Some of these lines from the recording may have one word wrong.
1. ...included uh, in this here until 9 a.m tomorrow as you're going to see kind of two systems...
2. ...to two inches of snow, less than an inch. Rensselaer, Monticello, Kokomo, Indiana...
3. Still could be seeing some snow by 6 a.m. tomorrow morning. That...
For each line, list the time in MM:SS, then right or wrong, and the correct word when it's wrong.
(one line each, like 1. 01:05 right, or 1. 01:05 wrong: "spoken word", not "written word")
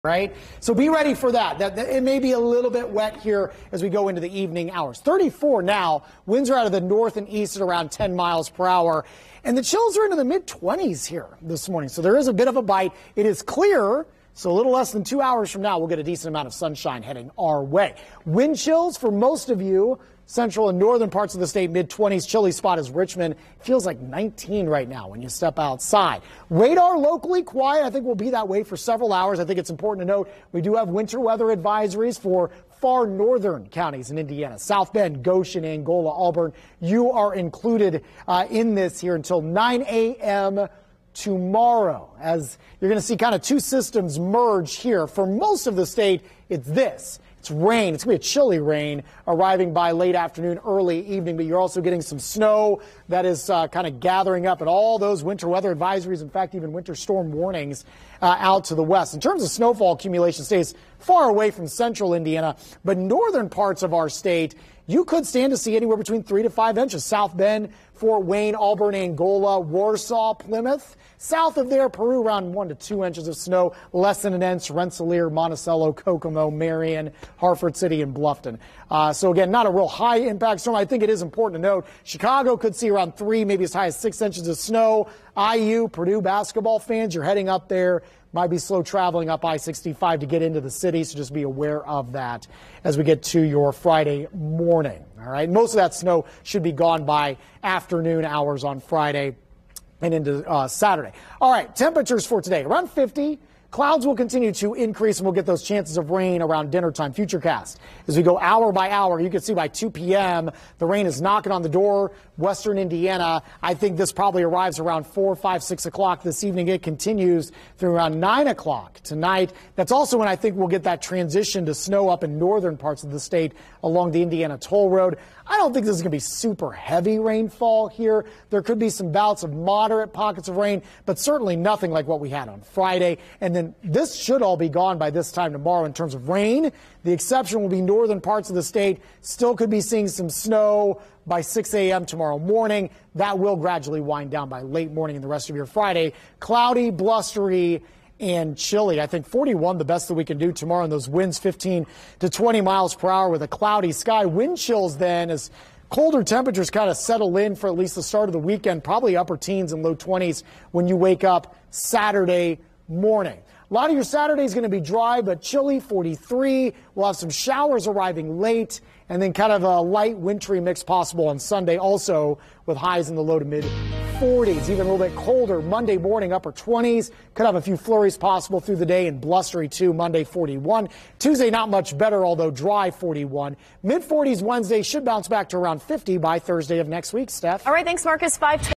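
1. 00:37 right
2. 01:12 wrong: "Marion", not "Indiana"
3. 02:19 right.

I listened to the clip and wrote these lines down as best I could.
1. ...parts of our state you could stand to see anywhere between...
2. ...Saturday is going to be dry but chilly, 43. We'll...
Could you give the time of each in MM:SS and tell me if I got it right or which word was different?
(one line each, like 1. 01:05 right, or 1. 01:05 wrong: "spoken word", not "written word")
1. 01:03 right
2. 02:44 right.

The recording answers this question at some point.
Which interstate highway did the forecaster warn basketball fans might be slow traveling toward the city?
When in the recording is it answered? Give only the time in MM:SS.
01:29.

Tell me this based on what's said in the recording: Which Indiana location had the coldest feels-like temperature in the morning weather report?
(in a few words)
Richmond.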